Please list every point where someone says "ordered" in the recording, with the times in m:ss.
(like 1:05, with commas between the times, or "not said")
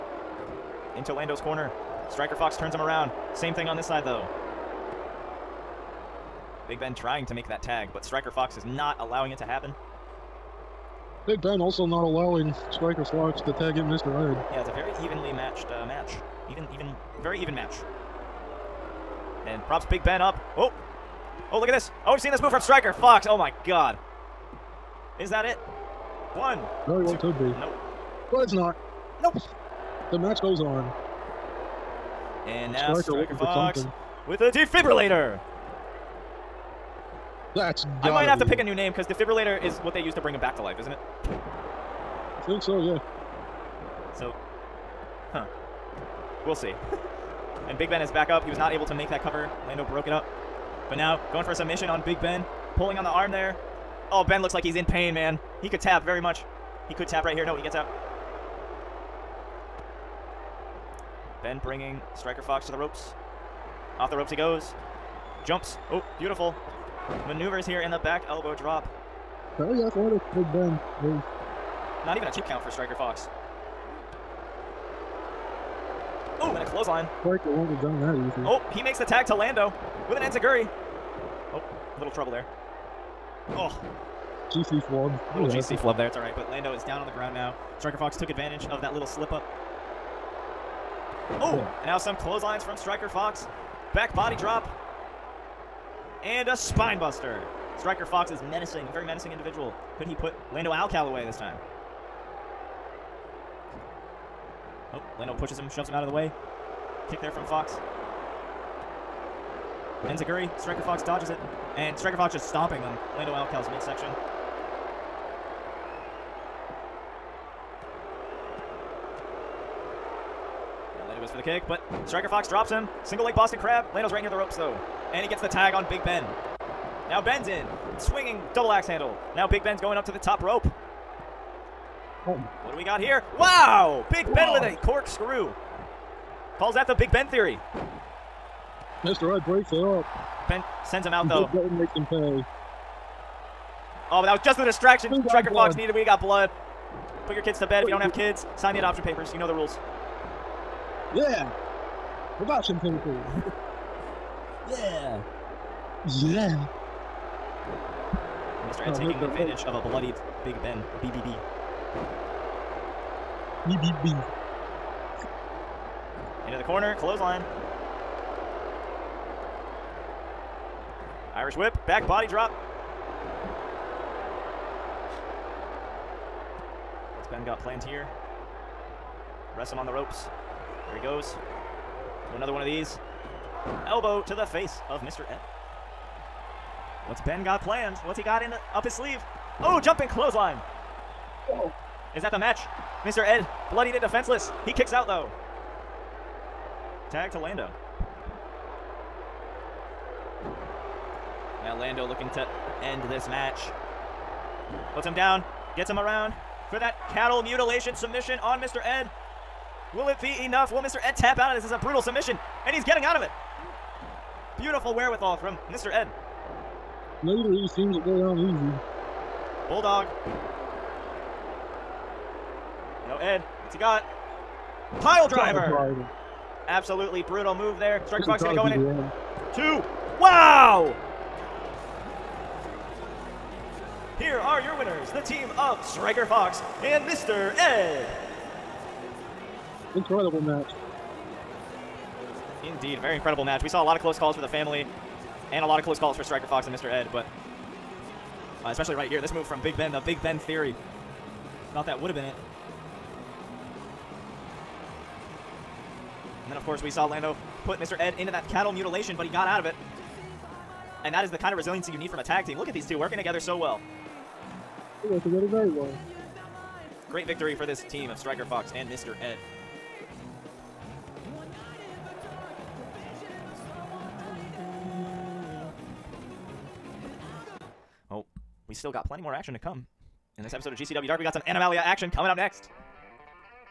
not said.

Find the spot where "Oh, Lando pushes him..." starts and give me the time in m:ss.
1:44.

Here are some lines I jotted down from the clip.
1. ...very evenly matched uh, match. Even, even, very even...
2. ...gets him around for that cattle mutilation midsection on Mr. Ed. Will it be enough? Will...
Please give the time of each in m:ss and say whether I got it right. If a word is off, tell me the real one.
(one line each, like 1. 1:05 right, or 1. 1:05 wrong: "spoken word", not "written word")
1. 0:14 right
2. 3:25 wrong: "submission", not "midsection".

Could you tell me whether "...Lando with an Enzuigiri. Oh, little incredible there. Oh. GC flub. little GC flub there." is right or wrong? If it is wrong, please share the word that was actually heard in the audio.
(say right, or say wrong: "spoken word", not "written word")
wrong: "trouble", not "incredible".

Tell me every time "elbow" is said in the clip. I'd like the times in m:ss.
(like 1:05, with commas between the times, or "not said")
1:08, 3:03.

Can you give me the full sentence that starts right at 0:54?
Oh, Ben looks like he's in pain, man.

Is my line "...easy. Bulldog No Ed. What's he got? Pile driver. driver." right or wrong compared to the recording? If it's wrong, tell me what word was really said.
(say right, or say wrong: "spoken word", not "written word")
right.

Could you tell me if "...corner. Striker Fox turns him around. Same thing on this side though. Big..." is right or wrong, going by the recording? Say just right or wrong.
right.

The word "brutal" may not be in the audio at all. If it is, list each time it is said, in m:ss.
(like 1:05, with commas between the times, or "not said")
3:31, 3:47.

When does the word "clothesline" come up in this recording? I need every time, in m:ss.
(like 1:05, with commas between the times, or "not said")
1:16, 1:32, 2:46, 3:10.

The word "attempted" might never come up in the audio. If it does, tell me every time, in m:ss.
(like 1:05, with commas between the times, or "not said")
not said.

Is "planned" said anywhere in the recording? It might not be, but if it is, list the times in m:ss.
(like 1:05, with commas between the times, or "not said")
2:57, 3:07.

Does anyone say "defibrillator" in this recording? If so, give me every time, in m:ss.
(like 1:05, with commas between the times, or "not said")
0:34, 0:39.